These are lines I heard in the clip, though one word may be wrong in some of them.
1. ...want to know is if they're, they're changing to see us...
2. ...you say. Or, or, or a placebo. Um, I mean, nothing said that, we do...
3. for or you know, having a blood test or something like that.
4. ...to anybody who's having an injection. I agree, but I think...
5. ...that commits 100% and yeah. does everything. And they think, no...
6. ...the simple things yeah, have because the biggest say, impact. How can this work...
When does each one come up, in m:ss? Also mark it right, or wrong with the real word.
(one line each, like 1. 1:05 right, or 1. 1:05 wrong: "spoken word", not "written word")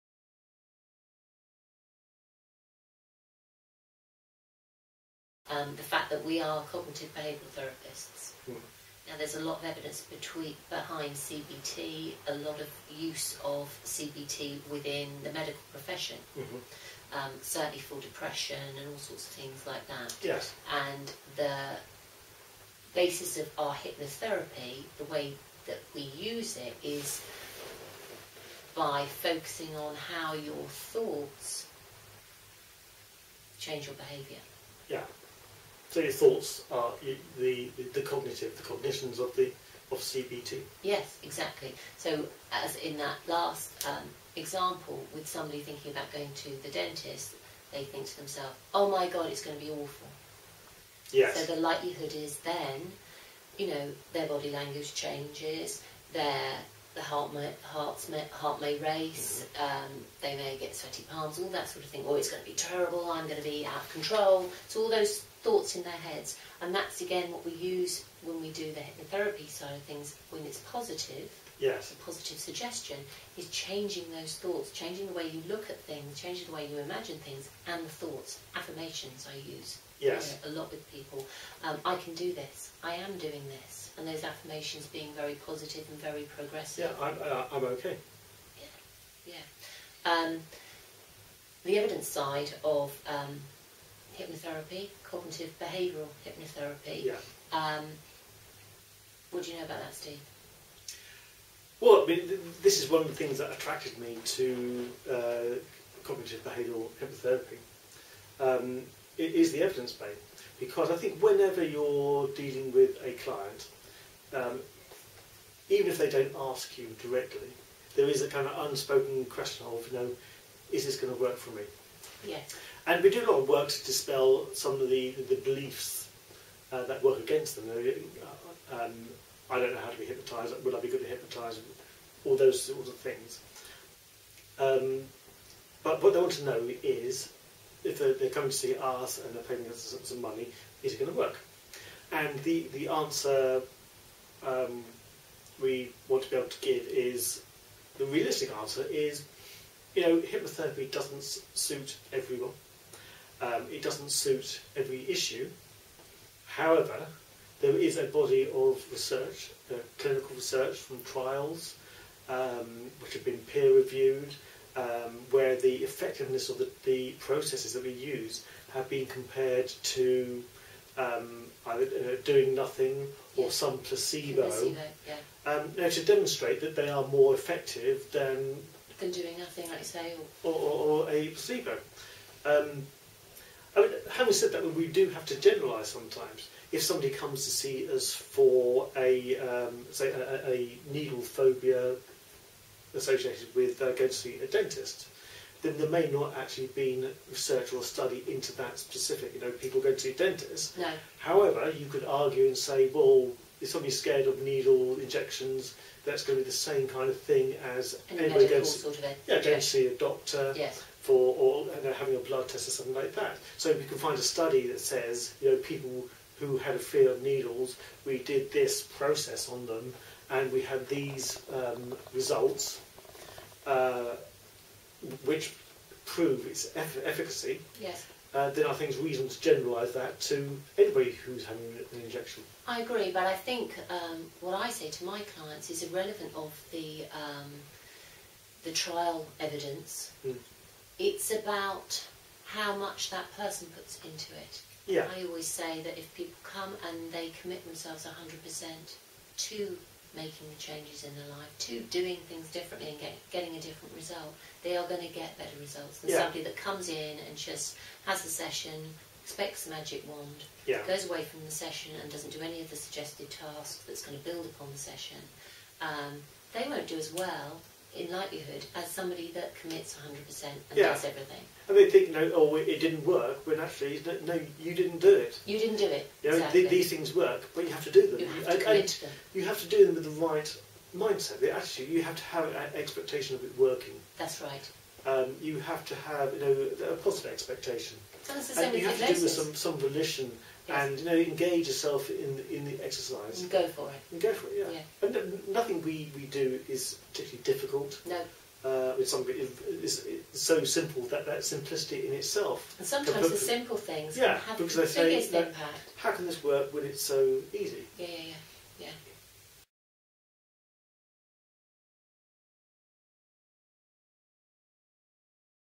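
1. 2:16 wrong: "coming", not "changing"
2. 2:59 wrong: "having", not "nothing"
3. 3:31 right
4. 3:50 right
5. 4:29 right
6. 5:03 right.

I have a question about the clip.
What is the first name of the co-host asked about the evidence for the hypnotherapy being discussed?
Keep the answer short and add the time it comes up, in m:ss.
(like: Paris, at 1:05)
Steve, at 1:39.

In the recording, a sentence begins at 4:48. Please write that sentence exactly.
So and you have to do with some, some volition and you know engage yourself in in the exercise.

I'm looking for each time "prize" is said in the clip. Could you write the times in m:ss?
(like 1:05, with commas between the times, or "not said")
not said.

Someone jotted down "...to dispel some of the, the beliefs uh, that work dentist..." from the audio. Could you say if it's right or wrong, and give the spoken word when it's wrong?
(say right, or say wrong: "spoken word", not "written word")
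wrong: "against", not "dentist".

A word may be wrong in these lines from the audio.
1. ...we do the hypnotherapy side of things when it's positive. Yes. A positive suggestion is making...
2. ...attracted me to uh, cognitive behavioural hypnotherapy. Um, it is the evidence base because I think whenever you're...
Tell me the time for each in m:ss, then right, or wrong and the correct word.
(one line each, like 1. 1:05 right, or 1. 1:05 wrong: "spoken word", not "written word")
1. 1:08 wrong: "changing", not "making"
2. 1:43 right.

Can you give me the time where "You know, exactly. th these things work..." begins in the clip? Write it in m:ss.
4:36.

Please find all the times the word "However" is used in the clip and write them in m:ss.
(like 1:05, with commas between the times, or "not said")
2:36, 3:21.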